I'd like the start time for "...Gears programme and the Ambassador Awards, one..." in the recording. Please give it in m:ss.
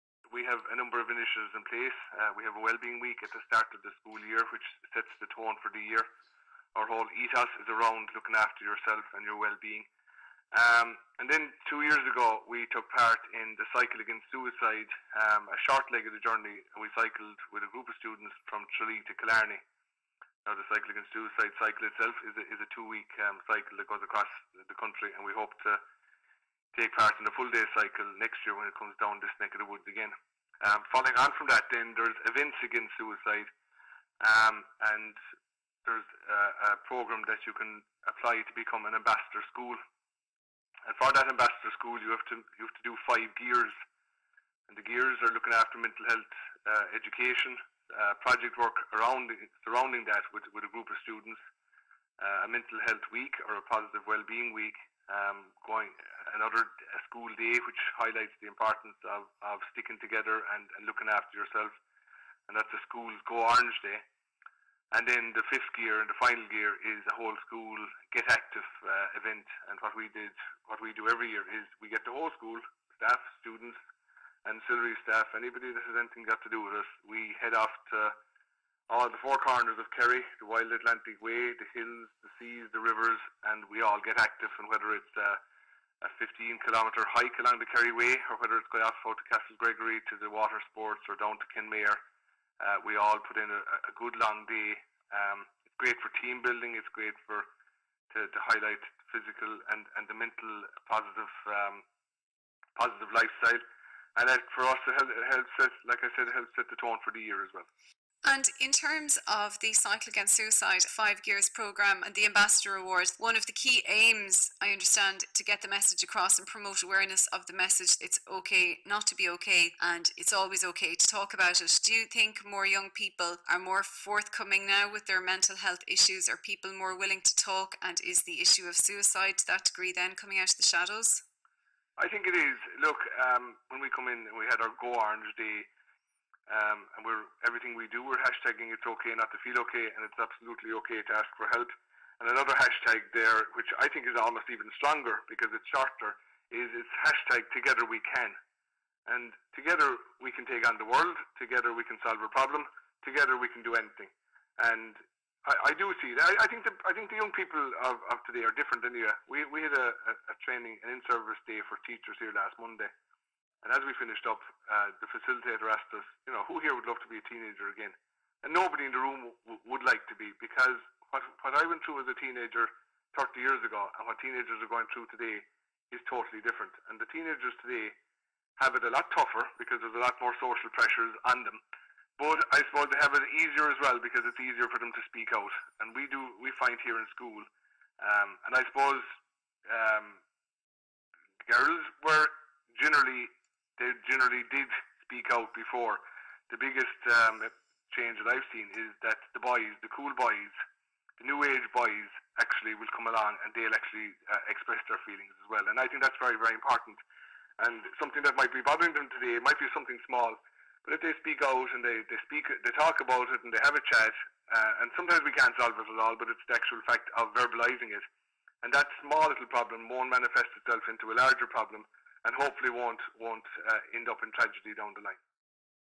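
1:51.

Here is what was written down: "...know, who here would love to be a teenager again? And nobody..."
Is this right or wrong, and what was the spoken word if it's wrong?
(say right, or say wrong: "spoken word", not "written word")
right.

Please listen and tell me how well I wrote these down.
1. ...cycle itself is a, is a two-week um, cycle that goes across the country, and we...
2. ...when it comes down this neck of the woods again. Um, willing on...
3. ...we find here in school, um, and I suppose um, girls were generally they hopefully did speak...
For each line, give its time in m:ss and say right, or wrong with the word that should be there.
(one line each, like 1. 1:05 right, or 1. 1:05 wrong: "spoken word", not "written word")
1. 0:21 right
2. 0:28 wrong: "following", not "willing"
3. 3:06 wrong: "generally", not "hopefully".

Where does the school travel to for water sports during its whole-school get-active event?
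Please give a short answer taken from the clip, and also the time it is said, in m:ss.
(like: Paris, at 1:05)
Castlegregory, at 1:29.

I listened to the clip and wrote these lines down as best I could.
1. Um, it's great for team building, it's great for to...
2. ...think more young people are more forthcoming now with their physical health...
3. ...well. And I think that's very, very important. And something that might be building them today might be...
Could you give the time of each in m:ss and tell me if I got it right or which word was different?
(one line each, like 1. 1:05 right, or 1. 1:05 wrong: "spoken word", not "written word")
1. 1:35 right
2. 2:02 wrong: "mental", not "physical"
3. 3:25 wrong: "bothering", not "building".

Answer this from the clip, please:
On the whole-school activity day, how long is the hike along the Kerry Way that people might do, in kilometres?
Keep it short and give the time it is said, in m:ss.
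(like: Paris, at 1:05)
15, at 1:26.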